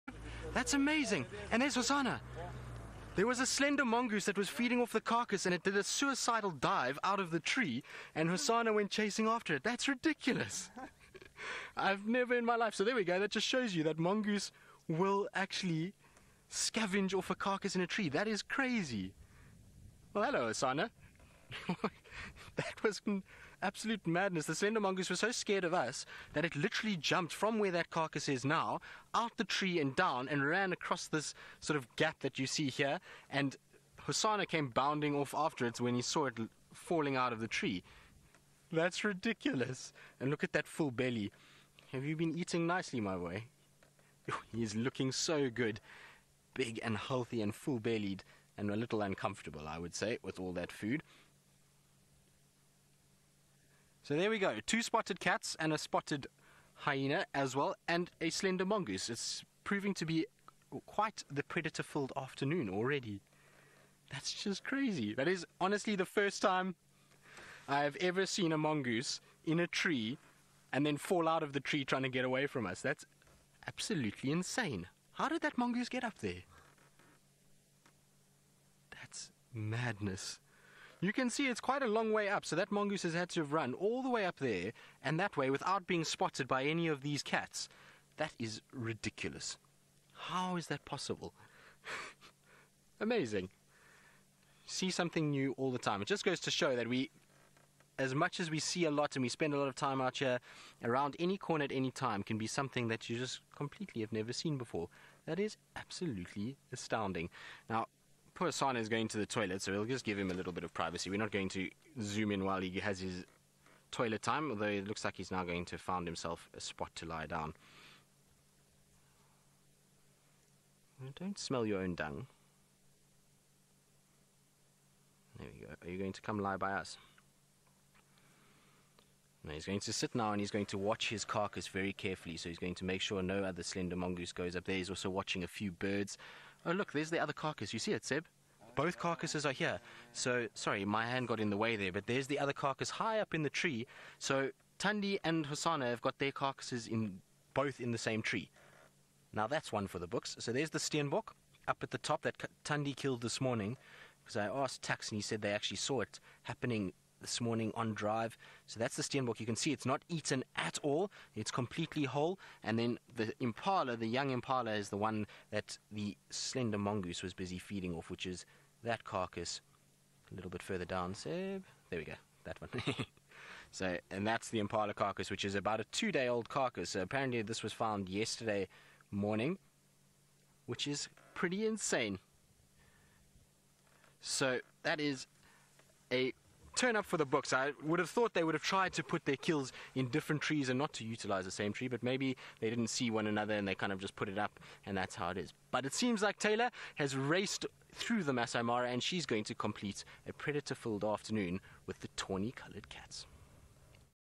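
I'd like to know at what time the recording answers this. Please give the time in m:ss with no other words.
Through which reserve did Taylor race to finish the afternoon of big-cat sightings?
3:18.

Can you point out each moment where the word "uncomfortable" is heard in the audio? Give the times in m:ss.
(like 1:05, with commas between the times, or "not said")
0:49.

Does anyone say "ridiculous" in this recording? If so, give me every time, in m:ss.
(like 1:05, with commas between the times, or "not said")
0:09, 0:39, 1:28.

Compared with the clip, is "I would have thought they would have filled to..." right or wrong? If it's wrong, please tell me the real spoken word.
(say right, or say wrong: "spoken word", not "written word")
wrong: "tried", not "filled".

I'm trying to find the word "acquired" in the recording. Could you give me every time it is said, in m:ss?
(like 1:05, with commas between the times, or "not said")
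not said.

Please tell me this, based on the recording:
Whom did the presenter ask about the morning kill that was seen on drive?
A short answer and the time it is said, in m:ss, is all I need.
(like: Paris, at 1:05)
Tax, at 2:34.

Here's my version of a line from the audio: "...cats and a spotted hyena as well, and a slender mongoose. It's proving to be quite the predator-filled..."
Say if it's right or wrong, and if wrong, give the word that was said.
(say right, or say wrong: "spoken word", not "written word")
right.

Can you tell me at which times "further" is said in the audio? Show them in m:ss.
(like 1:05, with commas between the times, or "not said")
2:50.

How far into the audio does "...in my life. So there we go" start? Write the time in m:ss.
0:12.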